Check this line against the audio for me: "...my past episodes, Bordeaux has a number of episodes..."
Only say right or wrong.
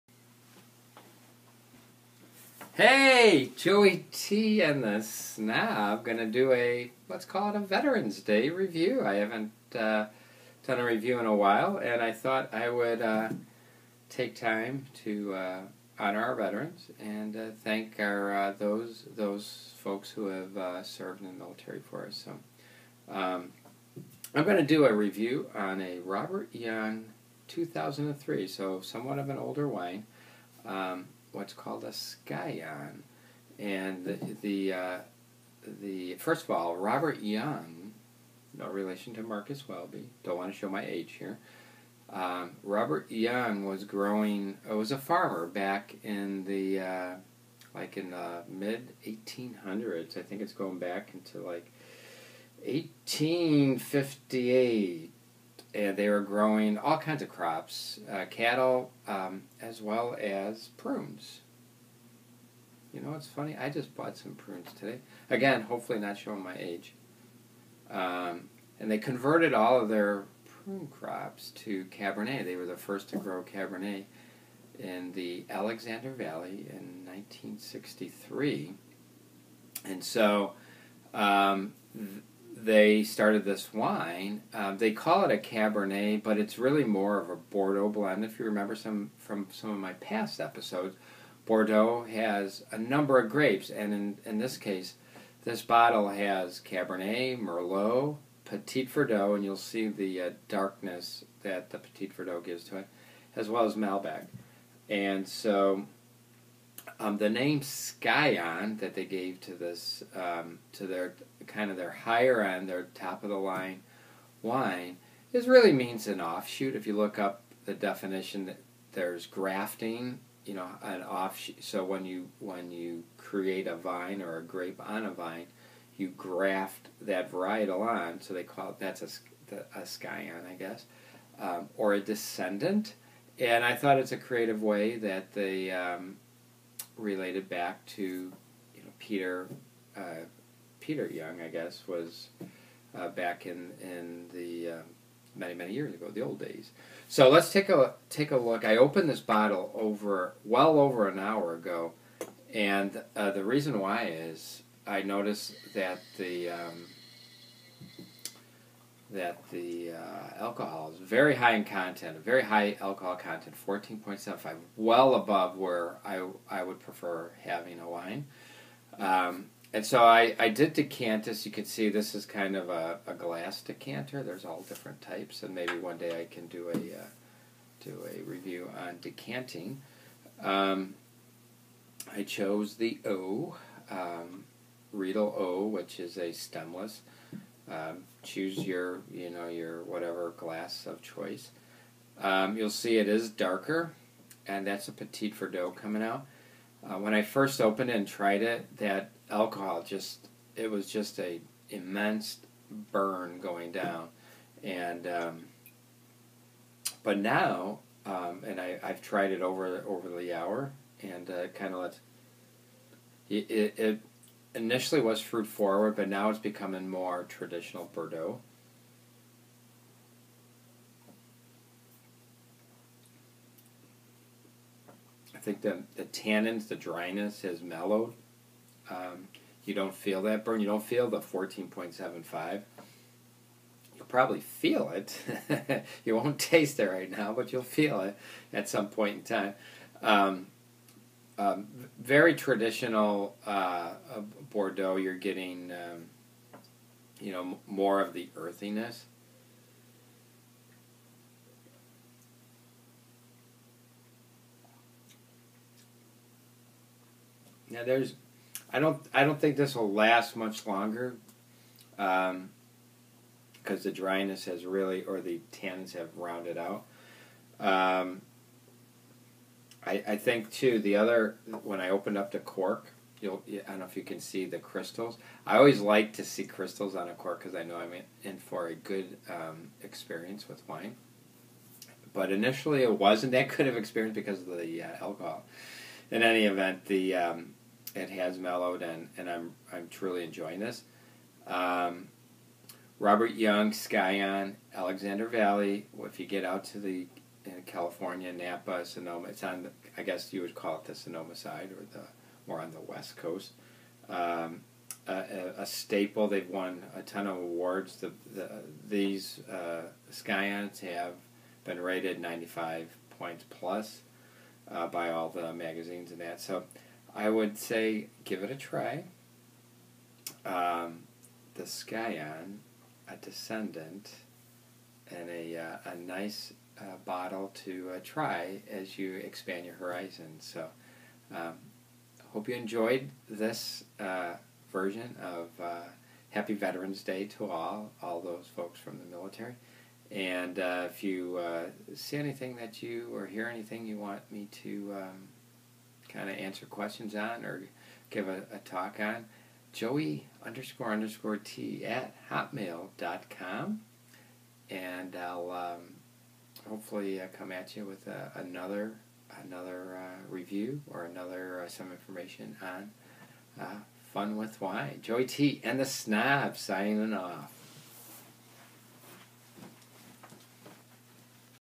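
wrong.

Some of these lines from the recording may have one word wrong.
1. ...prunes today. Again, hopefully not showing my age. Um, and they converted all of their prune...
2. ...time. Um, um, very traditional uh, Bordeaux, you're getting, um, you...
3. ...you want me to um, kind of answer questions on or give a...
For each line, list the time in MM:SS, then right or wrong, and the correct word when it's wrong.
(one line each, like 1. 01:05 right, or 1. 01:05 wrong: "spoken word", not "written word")
1. 01:04 right
2. 03:59 right
3. 05:43 right.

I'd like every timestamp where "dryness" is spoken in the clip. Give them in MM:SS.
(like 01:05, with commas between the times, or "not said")
03:46, 04:23.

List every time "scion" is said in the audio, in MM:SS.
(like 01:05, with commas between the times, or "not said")
00:31, 01:47, 02:09, 04:53, 05:10, 05:21.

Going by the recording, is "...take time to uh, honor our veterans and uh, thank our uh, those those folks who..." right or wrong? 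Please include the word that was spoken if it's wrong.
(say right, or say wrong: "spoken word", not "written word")
right.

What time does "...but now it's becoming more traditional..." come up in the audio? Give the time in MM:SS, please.
03:35.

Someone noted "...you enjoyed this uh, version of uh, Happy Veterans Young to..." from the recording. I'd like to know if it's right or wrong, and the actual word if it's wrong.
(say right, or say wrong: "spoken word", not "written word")
wrong: "Day", not "Young".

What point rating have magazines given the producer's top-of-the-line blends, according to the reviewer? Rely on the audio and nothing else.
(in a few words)
95 points plus.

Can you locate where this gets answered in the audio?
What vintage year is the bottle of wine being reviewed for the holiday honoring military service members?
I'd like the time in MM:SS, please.
00:27.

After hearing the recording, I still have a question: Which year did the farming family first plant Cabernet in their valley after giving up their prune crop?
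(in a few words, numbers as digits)
1963.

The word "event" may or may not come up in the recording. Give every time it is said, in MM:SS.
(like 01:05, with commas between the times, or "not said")
04:46.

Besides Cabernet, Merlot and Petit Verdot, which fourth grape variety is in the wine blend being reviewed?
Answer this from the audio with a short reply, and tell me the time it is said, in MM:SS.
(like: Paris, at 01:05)
Malbec, at 01:43.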